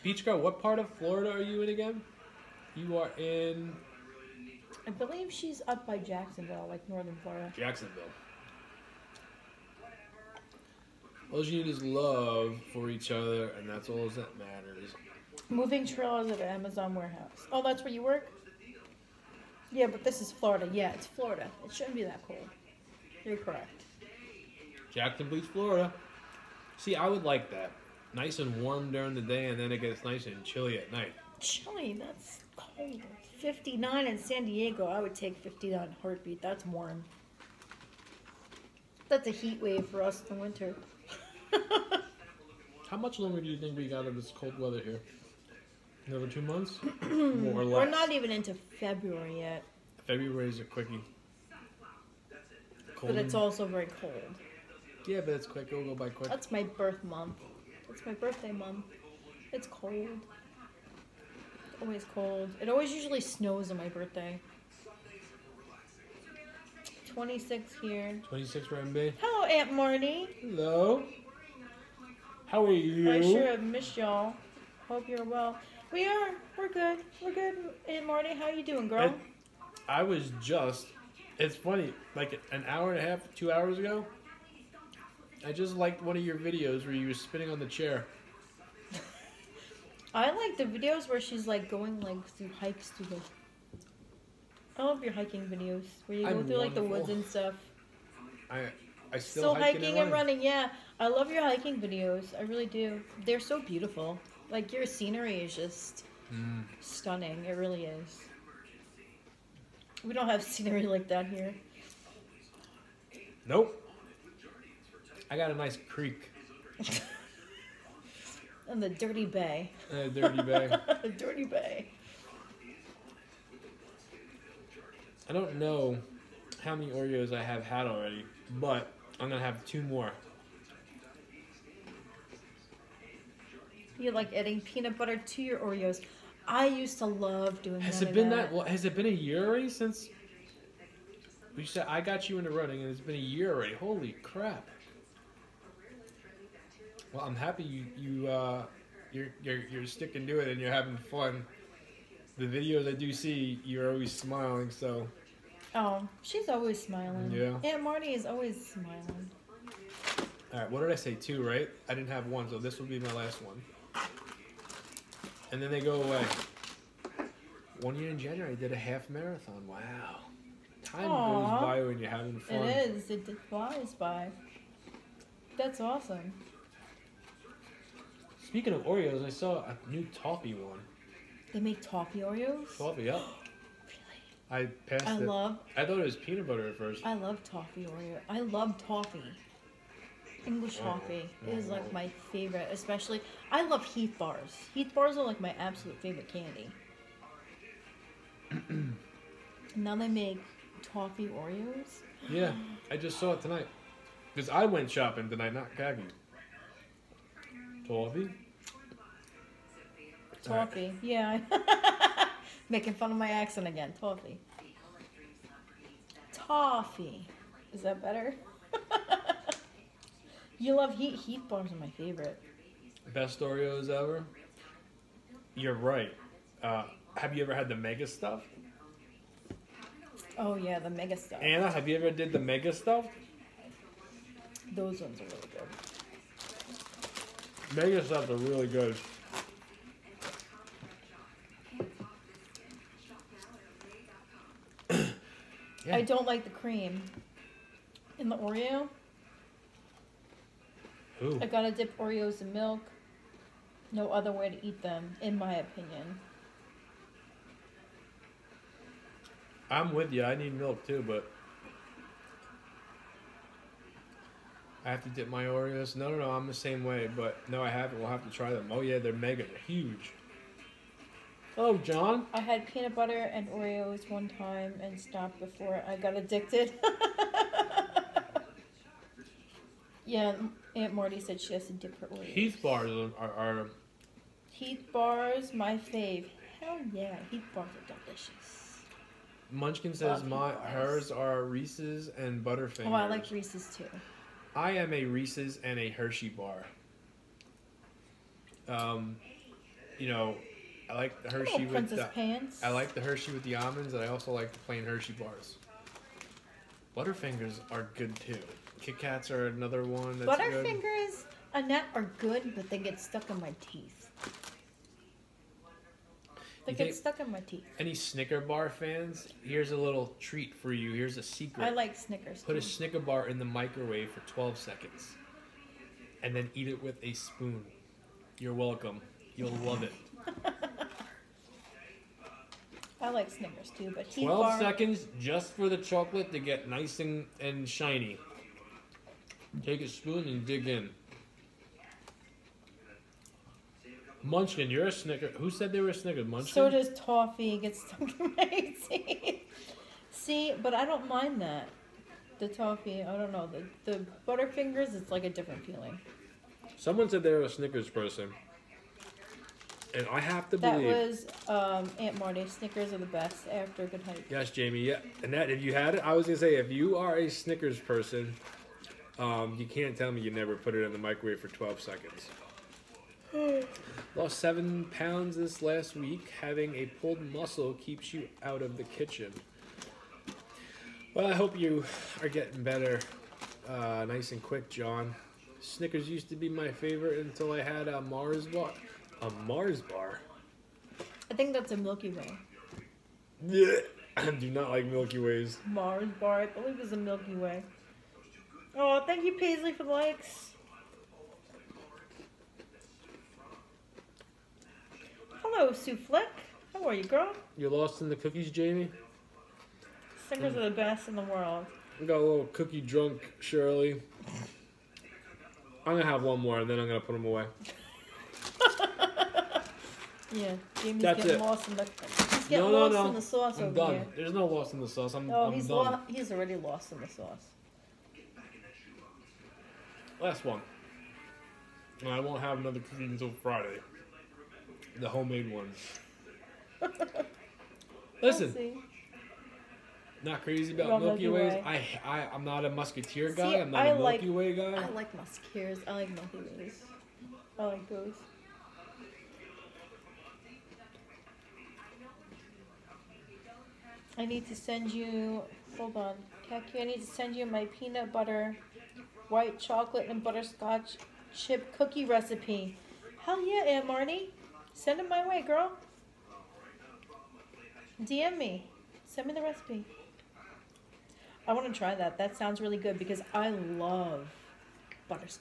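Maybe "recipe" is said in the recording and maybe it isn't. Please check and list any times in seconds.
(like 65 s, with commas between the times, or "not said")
462 s, 469 s.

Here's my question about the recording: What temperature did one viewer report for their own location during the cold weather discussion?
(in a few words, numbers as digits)
26.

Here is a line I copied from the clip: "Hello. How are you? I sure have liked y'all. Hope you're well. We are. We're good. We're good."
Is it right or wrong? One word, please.
wrong.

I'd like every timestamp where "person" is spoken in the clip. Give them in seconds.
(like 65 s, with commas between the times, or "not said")
357 s, 367 s.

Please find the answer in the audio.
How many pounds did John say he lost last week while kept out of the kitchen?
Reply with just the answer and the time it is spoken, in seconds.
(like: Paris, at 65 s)
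7, at 374 s.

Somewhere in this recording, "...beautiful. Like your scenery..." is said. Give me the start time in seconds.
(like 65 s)
103 s.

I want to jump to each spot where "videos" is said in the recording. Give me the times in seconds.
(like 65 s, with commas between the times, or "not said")
86 s, 90 s, 95 s, 101 s, 152 s.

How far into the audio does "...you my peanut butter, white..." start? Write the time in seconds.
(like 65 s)
457 s.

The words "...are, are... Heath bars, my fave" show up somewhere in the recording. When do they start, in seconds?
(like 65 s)
283 s.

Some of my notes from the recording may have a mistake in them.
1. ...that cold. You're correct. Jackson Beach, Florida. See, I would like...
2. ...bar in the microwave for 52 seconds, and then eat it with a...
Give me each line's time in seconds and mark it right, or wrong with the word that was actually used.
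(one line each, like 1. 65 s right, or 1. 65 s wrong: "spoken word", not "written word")
1. 22 s right
2. 323 s wrong: "12", not "52".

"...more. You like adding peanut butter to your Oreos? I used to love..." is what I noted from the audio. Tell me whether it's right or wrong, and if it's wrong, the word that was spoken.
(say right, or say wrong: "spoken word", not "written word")
right.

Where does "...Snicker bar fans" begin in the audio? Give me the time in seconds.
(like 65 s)
317 s.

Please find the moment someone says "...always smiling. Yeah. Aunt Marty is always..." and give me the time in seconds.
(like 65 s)
156 s.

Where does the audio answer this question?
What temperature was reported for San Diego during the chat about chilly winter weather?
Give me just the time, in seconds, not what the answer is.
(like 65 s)
33 s.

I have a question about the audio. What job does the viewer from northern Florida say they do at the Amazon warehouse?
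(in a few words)
Moving trailers.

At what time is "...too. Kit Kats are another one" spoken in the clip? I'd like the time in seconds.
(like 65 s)
308 s.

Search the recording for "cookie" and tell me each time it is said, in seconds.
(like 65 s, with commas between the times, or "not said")
408 s, 412 s, 432 s, 461 s.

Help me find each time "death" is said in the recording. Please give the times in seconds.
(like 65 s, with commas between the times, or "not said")
not said.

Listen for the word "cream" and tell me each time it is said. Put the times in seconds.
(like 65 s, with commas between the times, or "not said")
246 s.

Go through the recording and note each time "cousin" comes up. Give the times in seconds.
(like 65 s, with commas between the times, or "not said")
not said.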